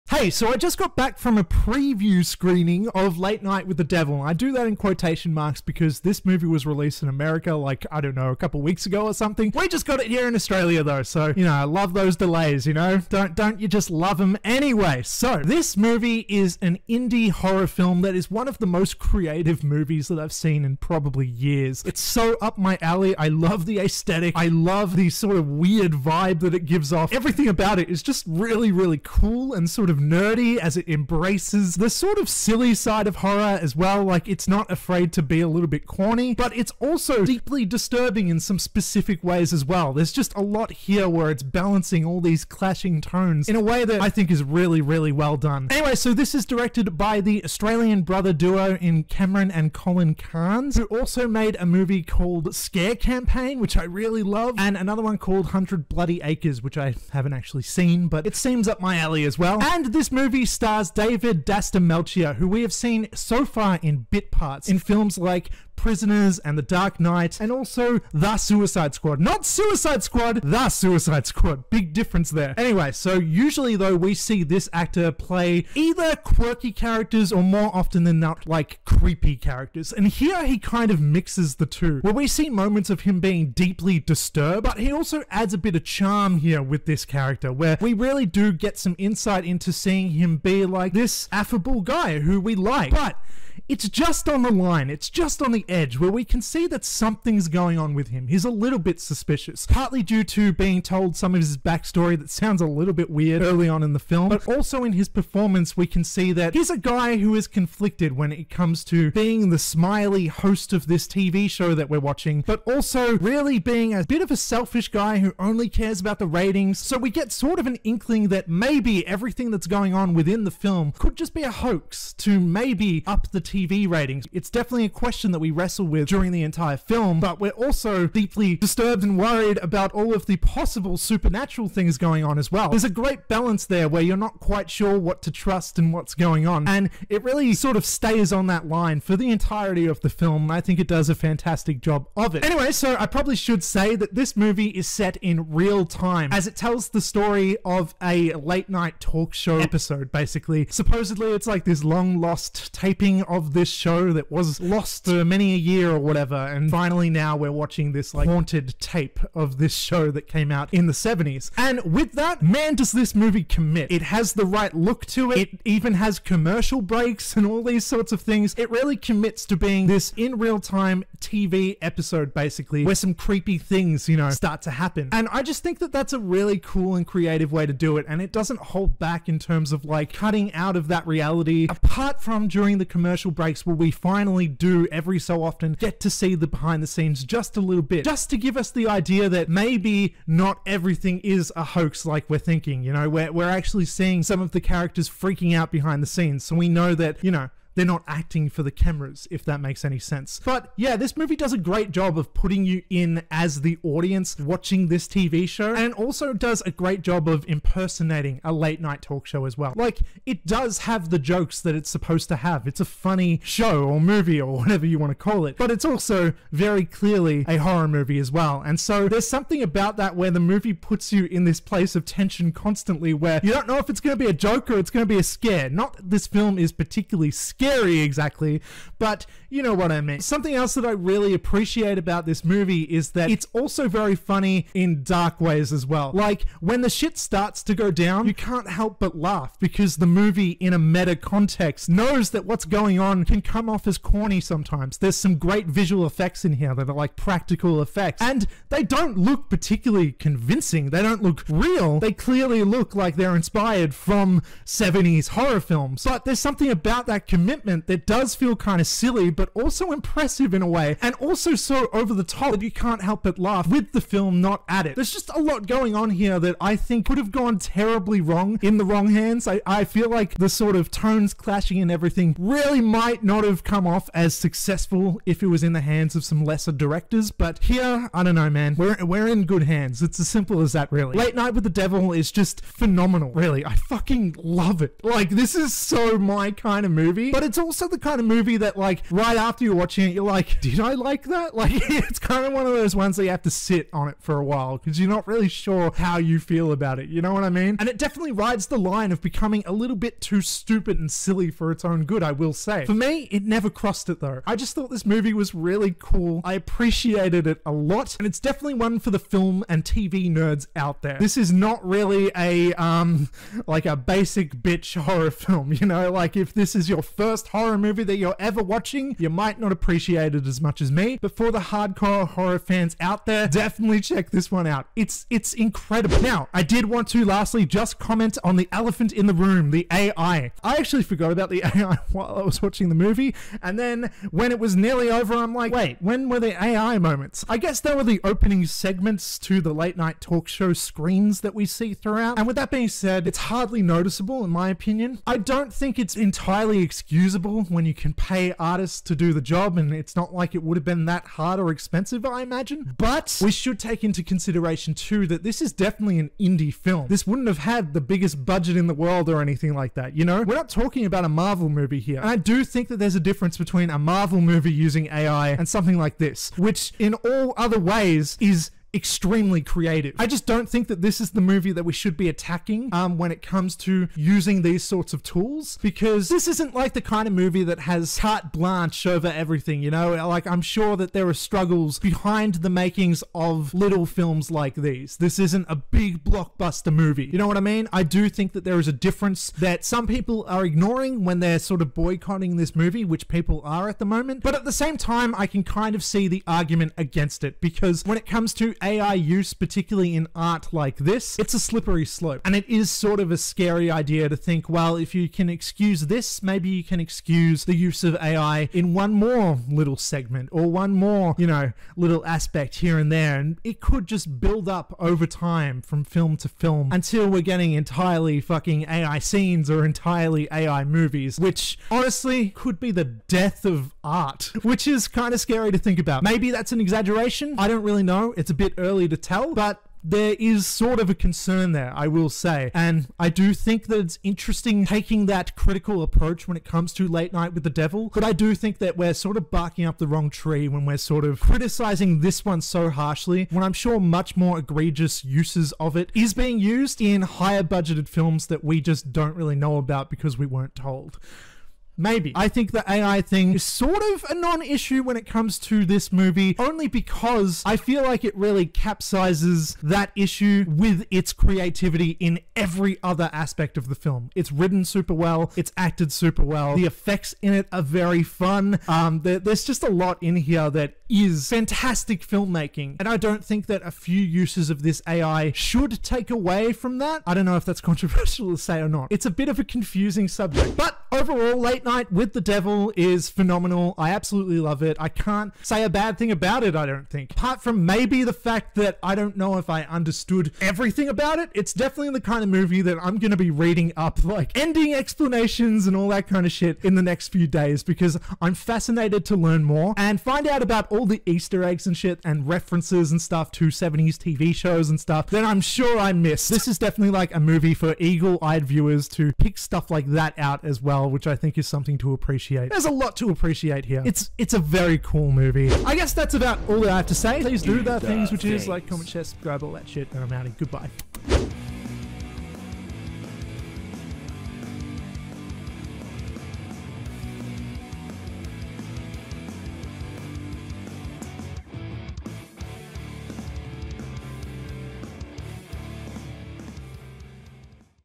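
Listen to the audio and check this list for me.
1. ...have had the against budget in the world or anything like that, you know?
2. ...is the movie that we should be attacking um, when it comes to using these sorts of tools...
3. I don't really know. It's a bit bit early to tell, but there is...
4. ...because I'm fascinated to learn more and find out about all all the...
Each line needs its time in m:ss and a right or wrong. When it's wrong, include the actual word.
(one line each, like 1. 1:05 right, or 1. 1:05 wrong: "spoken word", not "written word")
1. 5:57 wrong: "biggest", not "against"
2. 6:11 right
3. 7:07 right
4. 8:17 right.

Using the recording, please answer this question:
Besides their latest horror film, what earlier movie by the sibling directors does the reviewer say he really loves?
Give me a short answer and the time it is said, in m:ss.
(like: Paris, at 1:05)
Scare Campaign, at 0:52.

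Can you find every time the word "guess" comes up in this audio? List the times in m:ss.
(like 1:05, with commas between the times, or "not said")
5:37, 8:35.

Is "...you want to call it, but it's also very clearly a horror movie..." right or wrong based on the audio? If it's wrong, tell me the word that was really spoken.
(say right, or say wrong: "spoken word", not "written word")
right.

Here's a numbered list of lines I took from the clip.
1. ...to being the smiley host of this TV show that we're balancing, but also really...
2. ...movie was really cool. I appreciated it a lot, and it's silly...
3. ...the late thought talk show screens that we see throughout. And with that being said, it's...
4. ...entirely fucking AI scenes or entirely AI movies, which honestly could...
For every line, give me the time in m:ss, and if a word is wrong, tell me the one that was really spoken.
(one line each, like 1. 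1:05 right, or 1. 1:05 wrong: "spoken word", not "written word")
1. 1:48 wrong: "watching", not "balancing"
2. 5:05 wrong: "definitely", not "silly"
3. 5:39 wrong: "night", not "thought"
4. 6:57 right.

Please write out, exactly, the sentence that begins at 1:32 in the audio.
But it's just on the line, it's just on the edge where we can see that something's going on with him.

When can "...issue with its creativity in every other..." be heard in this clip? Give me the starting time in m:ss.
7:40.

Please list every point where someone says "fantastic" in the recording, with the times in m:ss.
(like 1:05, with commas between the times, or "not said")
2:21, 7:51.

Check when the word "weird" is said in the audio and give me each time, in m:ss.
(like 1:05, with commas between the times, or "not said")
0:25, 1:43.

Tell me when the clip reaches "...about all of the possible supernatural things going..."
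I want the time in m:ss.
2:09.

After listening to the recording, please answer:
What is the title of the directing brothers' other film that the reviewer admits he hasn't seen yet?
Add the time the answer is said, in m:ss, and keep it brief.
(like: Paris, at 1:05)
Hundred Bloody Acres, at 0:55.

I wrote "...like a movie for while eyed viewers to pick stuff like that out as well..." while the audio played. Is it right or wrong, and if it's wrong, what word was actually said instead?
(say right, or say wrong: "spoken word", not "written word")
wrong: "eagle", not "while".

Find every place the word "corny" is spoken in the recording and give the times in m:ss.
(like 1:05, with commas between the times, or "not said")
0:35, 4:03.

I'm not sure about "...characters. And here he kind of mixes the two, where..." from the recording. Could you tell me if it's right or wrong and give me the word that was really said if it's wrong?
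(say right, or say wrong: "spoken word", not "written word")
right.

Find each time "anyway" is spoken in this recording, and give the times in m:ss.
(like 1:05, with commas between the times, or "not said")
0:14, 0:45, 1:12, 2:22.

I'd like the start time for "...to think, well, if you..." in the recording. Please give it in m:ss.
6:44.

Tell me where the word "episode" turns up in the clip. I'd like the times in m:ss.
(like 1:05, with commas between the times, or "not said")
2:29, 2:51.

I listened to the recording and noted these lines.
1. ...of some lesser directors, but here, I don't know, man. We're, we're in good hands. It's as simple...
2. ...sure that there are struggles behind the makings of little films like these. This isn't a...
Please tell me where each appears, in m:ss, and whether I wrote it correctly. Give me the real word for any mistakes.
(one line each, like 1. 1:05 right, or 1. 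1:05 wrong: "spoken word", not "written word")
1. 4:36 right
2. 6:20 right.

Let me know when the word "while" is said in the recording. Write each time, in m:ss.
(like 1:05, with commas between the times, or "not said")
4:54, 5:32.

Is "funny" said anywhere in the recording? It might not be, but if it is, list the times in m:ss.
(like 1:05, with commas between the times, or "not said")
3:32, 3:54.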